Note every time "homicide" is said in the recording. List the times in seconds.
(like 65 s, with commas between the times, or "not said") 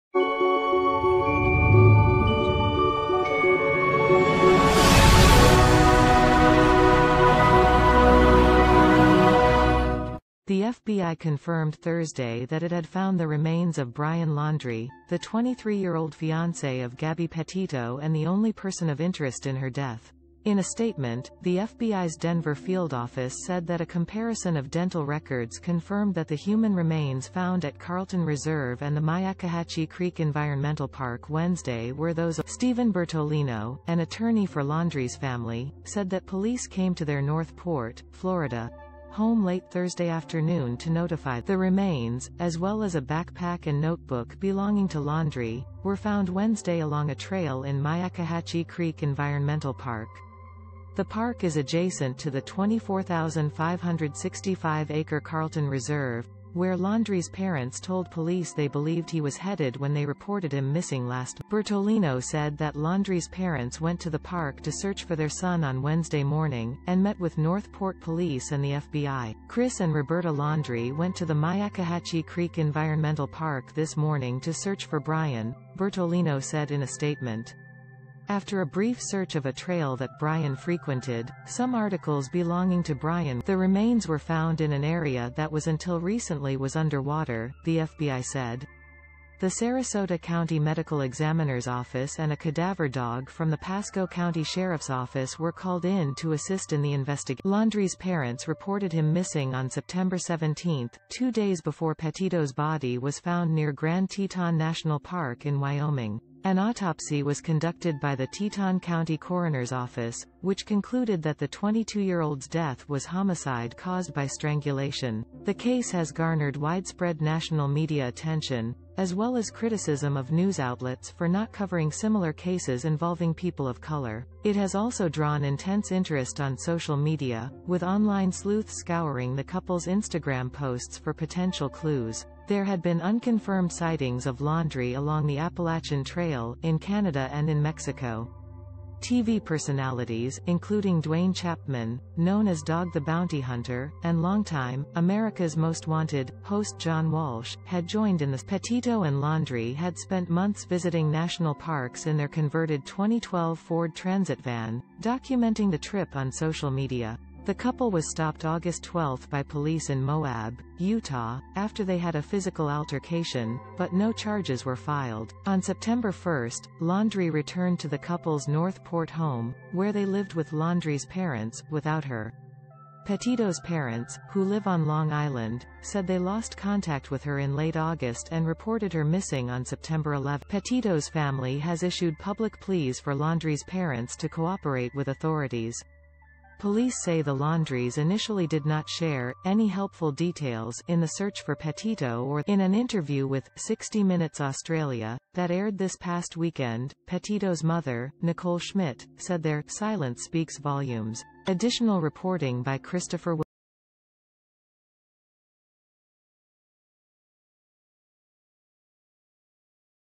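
113 s.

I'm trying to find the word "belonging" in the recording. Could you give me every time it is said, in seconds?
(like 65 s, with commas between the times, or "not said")
44 s, 82 s.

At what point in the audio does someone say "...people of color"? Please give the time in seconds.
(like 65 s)
123 s.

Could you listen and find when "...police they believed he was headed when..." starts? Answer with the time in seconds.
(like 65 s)
58 s.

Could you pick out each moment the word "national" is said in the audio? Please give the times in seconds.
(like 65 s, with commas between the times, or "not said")
104 s, 117 s, 151 s.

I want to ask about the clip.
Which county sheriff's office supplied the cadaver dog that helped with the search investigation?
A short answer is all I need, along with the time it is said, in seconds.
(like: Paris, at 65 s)
Pasco County, at 93 s.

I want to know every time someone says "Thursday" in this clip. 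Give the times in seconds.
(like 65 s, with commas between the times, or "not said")
11 s, 39 s.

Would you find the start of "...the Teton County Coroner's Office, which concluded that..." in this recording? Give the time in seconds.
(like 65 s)
108 s.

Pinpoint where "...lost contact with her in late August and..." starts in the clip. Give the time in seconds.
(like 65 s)
176 s.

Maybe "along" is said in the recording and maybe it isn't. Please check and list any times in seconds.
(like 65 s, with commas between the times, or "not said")
46 s, 134 s.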